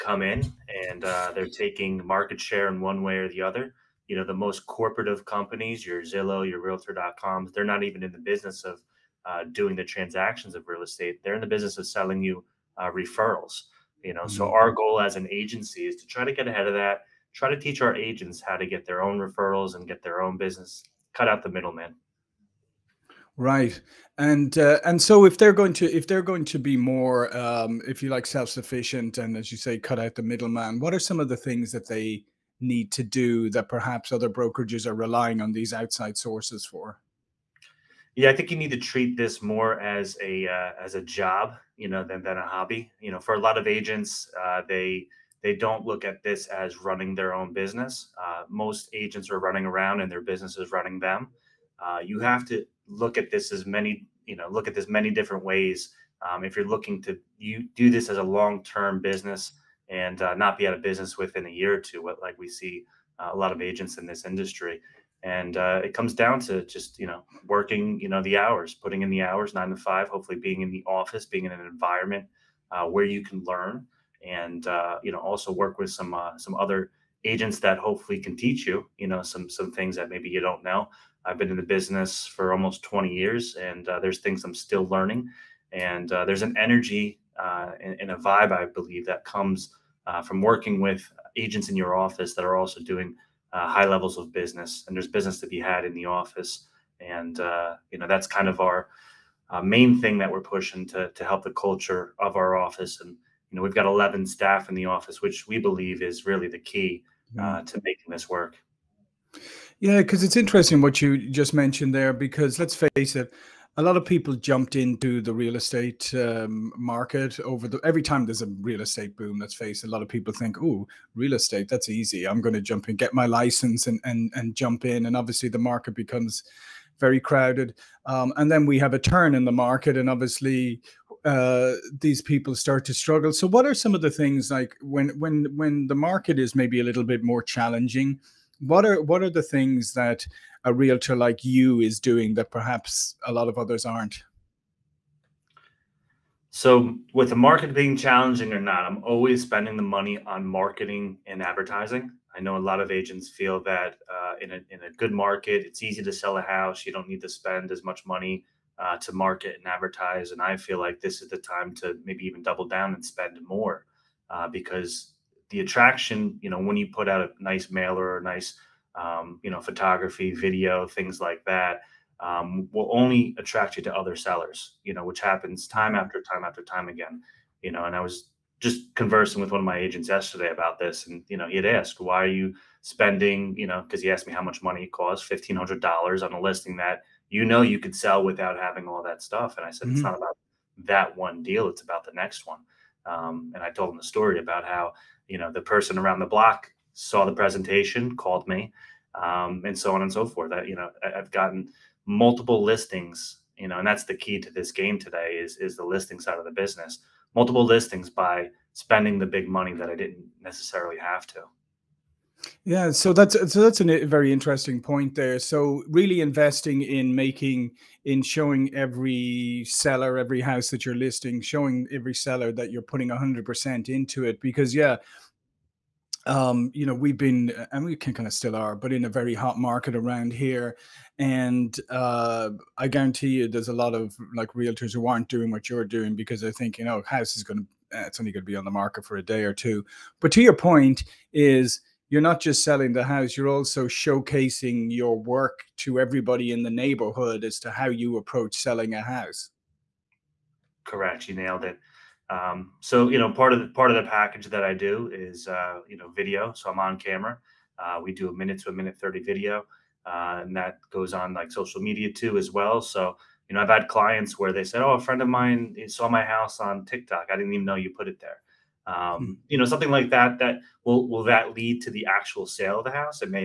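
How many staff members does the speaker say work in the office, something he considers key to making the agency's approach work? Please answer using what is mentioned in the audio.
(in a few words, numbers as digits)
11.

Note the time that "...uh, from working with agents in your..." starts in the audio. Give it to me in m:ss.
1:30.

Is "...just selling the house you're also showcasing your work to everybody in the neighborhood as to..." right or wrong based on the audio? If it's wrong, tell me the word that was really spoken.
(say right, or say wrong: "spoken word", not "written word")
right.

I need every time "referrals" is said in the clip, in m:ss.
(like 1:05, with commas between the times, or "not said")
0:12, 0:19.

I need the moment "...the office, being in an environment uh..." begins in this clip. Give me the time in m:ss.
1:10.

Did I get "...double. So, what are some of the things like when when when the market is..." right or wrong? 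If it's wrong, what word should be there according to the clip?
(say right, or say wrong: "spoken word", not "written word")
wrong: "struggle", not "double".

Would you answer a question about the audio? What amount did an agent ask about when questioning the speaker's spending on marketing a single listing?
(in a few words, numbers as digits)
$1,500.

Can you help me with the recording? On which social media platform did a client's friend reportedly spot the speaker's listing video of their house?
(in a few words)
TikTok.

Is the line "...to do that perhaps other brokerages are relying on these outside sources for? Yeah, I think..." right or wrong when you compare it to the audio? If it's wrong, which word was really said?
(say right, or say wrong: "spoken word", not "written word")
right.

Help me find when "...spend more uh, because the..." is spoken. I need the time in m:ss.
2:43.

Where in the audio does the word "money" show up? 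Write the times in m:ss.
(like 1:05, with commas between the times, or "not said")
2:29, 2:38, 3:04, 3:29.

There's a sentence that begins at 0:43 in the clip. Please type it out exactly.
You know, for a lot of agents, uh, they they don't look at this as running their own business.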